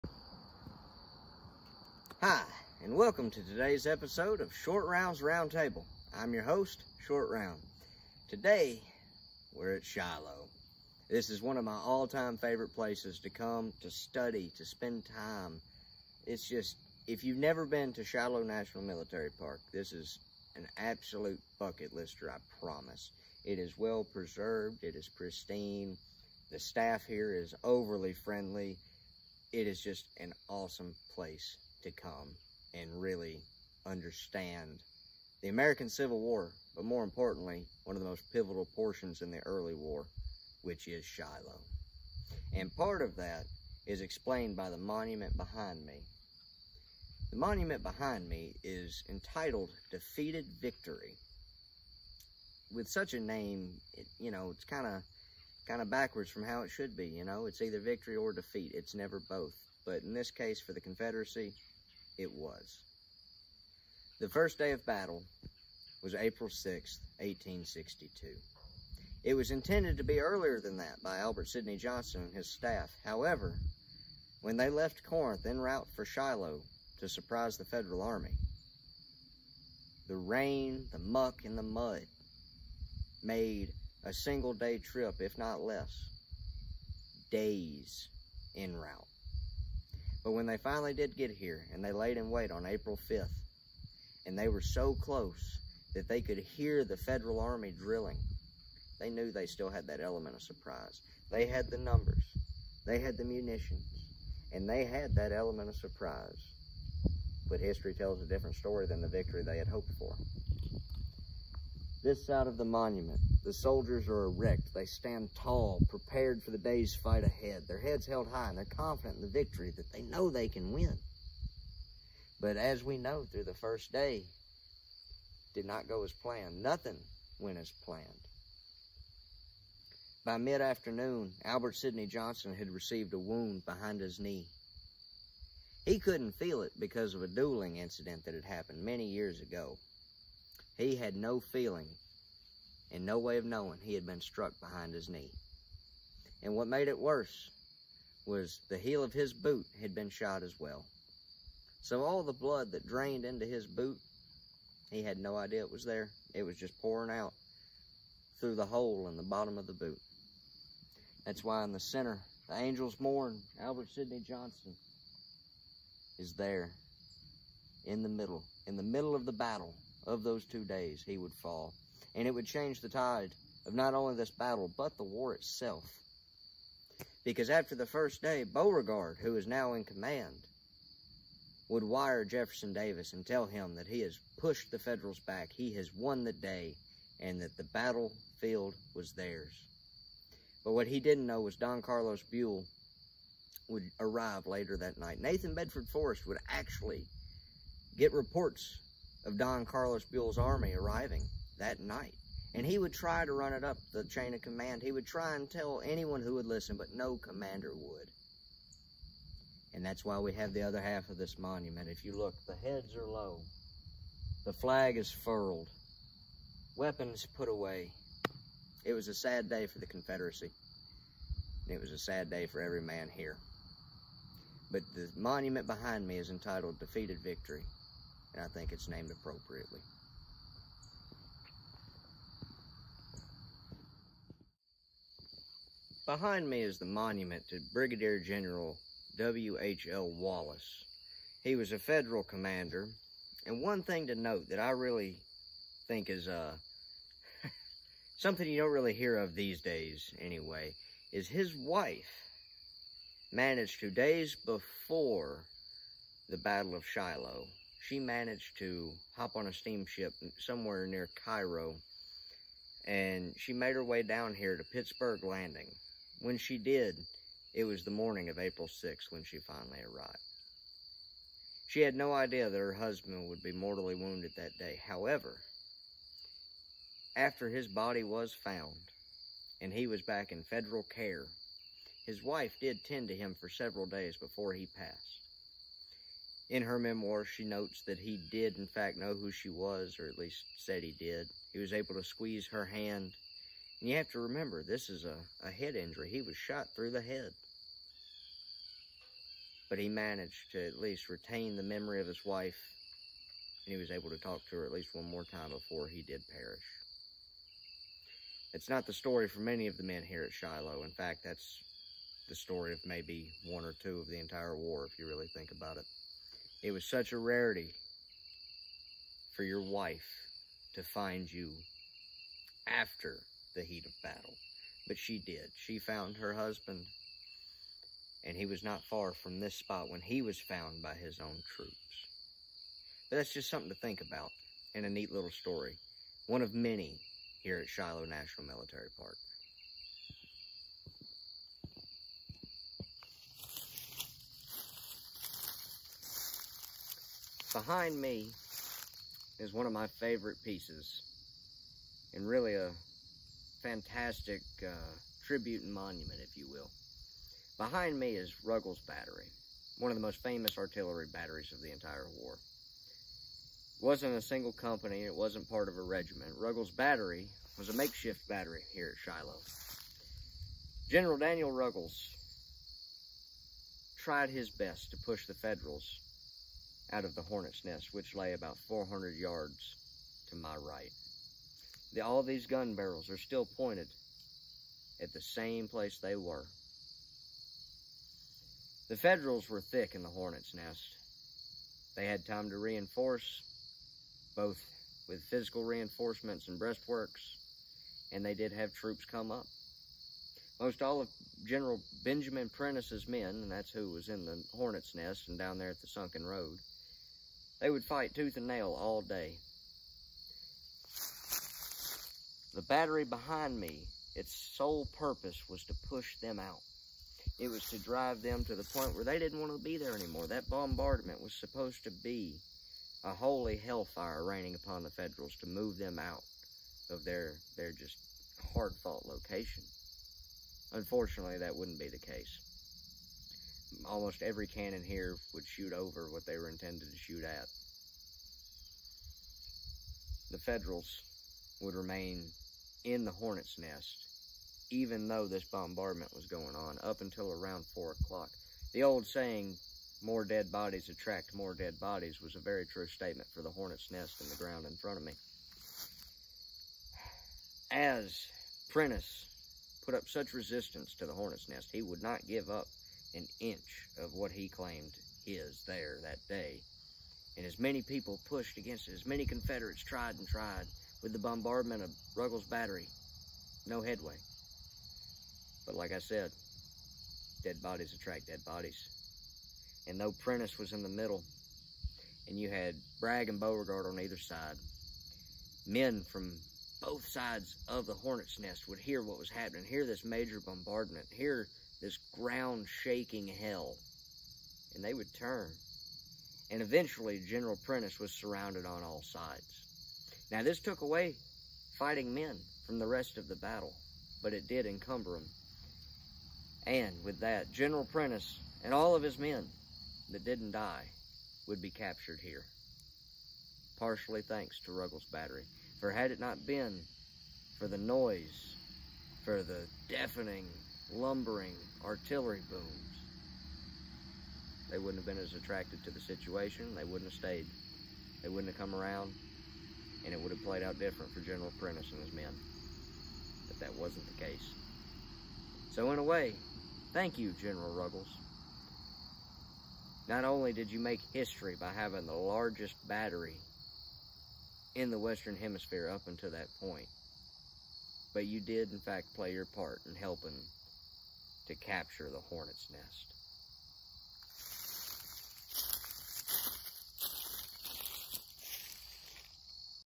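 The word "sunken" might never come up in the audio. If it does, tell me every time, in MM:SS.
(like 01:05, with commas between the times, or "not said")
06:45.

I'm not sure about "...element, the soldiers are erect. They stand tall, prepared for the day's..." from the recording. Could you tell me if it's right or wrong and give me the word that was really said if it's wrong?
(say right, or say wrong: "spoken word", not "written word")
wrong: "monument", not "element".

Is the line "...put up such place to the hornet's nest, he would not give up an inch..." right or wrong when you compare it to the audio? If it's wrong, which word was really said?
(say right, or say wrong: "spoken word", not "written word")
wrong: "resistance", not "place".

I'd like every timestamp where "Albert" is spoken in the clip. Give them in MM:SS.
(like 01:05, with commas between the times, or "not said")
01:11, 02:11, 02:43.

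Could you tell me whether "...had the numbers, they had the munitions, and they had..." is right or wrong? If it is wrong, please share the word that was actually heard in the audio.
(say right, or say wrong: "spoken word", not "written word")
right.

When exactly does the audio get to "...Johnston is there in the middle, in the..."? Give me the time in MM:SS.
02:44.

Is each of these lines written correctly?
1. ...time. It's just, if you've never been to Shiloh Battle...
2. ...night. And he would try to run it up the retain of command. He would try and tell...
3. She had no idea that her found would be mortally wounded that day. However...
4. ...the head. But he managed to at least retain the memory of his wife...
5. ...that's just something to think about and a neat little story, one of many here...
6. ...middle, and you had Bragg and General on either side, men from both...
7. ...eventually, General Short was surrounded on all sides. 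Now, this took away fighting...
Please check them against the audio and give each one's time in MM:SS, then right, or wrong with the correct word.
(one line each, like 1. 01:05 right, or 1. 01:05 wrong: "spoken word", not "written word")
1. 00:15 wrong: "National", not "Battle"
2. 03:21 wrong: "chain", not "retain"
3. 04:31 wrong: "husband", not "found"
4. 04:56 right
5. 05:33 right
6. 08:00 wrong: "Beauregard", not "General"
7. 08:16 wrong: "Prentiss", not "Short".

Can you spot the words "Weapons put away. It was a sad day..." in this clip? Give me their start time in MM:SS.
03:36.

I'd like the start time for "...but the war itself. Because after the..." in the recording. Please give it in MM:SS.
02:54.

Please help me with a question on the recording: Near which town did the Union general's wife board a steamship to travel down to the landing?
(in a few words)
Cairo.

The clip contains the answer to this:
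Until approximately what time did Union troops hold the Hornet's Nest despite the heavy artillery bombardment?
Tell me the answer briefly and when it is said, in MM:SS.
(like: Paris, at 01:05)
4 o'clock, at 07:27.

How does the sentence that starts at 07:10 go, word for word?
Unfortunately, that wouldn't be the case almost every cannon here would shoot over what they were intended to shoot at.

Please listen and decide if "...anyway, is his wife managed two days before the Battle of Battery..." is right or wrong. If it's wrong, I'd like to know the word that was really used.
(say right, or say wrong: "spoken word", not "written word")
wrong: "Shiloh", not "Battery".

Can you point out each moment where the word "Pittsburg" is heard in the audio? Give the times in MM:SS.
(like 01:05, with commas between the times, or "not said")
04:24.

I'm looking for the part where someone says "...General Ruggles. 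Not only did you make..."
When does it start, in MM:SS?
08:57.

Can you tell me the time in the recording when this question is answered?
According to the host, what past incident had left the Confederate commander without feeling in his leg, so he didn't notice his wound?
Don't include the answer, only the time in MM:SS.
02:17.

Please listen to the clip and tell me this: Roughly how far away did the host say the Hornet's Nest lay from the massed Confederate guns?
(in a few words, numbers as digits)
400 yards.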